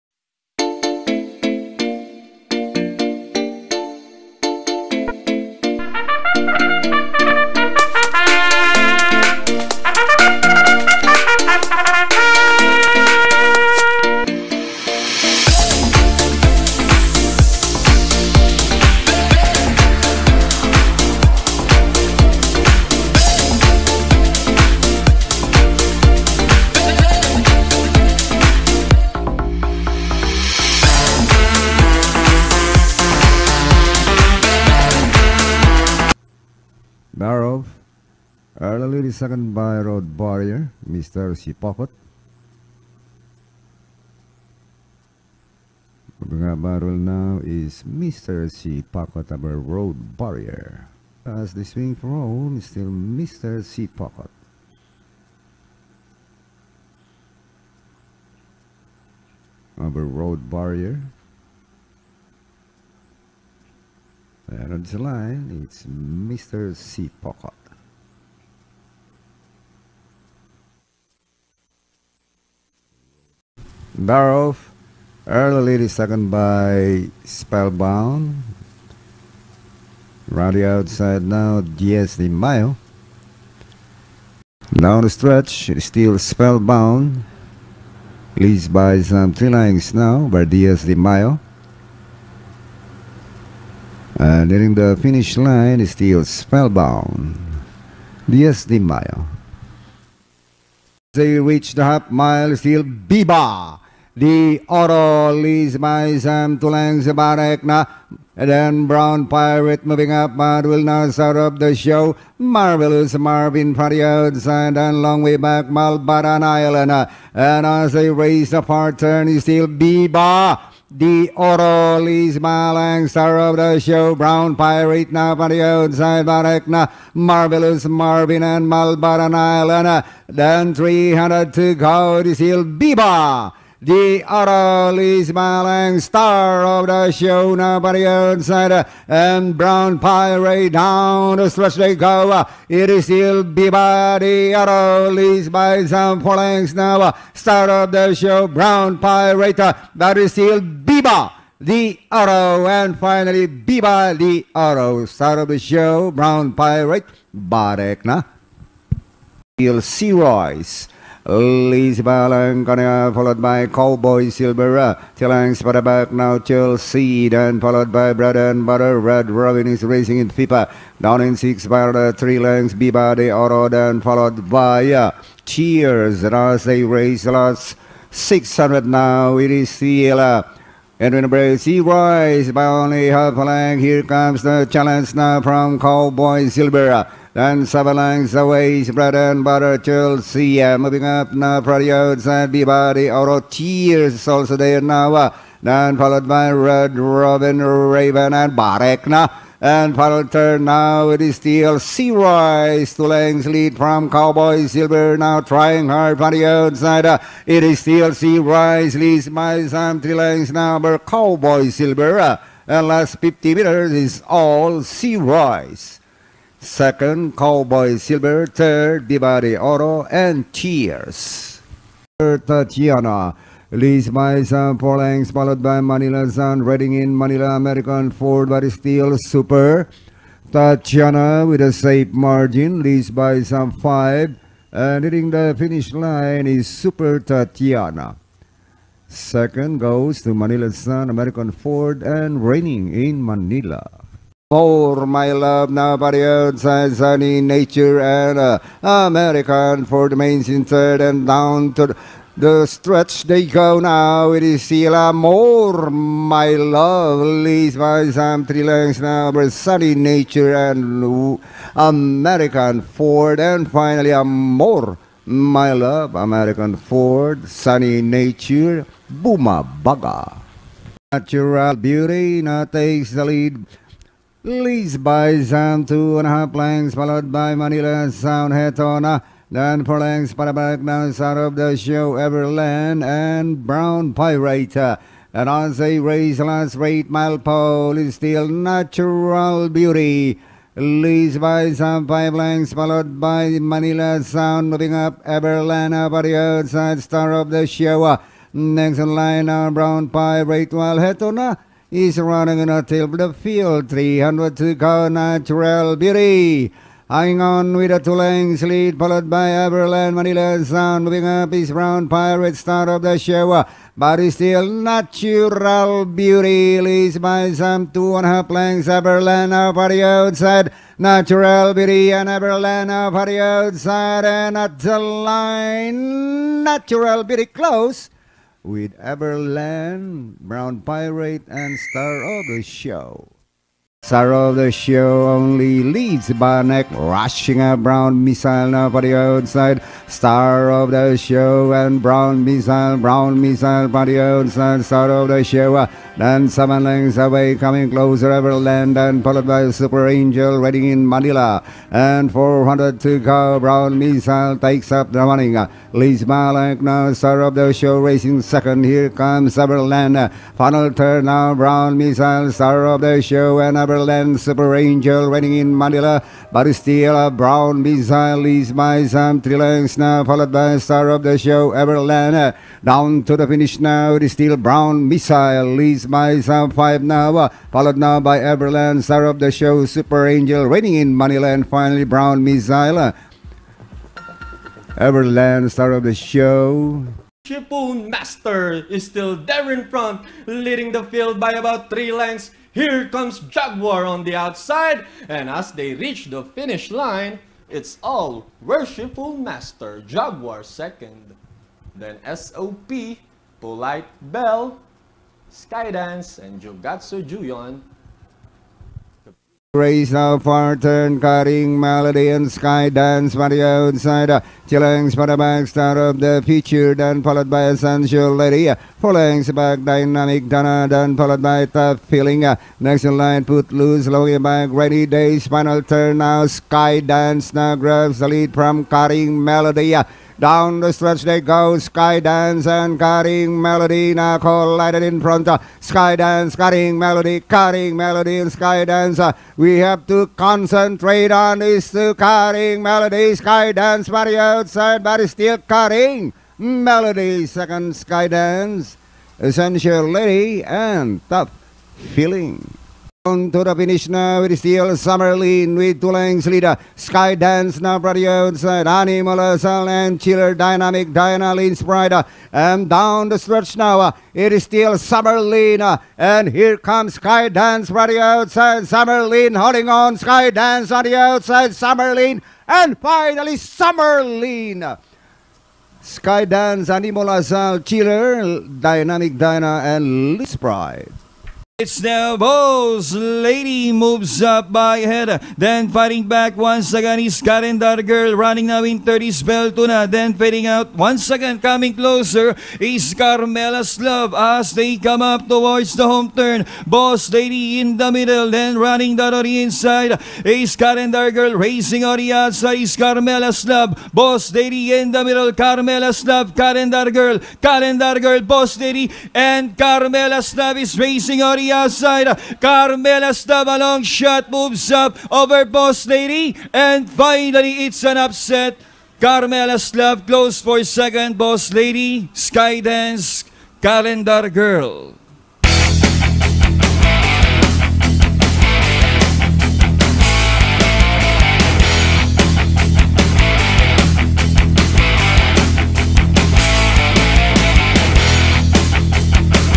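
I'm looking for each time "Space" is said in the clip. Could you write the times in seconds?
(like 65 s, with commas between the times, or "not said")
376 s.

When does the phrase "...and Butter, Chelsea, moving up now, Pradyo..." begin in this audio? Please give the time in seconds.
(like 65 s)
189 s.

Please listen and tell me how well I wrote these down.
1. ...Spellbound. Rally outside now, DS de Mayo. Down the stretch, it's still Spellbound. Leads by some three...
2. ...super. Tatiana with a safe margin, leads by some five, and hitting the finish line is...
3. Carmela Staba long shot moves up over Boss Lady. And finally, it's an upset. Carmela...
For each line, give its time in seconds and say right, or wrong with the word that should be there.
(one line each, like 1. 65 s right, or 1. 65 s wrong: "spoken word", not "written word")
1. 77 s right
2. 229 s right
3. 512 s right.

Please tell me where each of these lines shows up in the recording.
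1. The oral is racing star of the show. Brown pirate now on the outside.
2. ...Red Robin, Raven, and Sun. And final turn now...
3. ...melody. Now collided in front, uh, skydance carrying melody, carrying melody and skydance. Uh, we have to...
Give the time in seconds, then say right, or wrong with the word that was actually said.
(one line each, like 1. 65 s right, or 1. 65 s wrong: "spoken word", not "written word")
1. 120 s wrong: "malang", not "racing"
2. 196 s wrong: "Barekna", not "Sun"
3. 433 s right.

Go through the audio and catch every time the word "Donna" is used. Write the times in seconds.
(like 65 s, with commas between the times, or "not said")
420 s.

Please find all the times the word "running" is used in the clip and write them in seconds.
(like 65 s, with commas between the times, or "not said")
302 s, 355 s, 488 s, 498 s.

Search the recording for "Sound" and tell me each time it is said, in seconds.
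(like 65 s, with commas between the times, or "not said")
278 s, 294 s, 310 s.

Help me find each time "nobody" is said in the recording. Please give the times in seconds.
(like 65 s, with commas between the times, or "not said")
137 s, 245 s.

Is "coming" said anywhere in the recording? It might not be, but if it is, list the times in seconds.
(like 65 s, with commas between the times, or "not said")
347 s, 491 s.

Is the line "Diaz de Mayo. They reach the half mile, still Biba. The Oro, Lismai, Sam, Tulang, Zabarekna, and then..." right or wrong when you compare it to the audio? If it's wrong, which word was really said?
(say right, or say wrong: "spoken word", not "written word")
right.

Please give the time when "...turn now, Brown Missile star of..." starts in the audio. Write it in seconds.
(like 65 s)
360 s.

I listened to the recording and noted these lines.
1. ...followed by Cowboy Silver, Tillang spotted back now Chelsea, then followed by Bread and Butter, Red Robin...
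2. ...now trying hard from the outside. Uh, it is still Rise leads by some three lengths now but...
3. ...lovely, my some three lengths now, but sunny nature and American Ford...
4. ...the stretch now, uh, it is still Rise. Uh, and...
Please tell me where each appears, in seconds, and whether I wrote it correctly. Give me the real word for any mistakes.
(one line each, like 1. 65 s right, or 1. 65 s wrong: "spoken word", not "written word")
1. 163 s right
2. 205 s right
3. 257 s right
4. 463 s wrong: "Summerlin", not "Rise".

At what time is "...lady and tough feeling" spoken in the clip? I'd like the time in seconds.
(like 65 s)
450 s.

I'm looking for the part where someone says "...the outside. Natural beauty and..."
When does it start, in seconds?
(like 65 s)
319 s.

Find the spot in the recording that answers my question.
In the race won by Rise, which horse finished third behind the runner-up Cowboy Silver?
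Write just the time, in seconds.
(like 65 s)
219 s.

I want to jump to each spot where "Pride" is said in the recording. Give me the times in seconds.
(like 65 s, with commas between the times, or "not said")
461 s, 480 s.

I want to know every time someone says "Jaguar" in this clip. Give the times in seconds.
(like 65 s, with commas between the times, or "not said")
393 s, 400 s.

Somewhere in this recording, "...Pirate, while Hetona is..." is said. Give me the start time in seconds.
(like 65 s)
300 s.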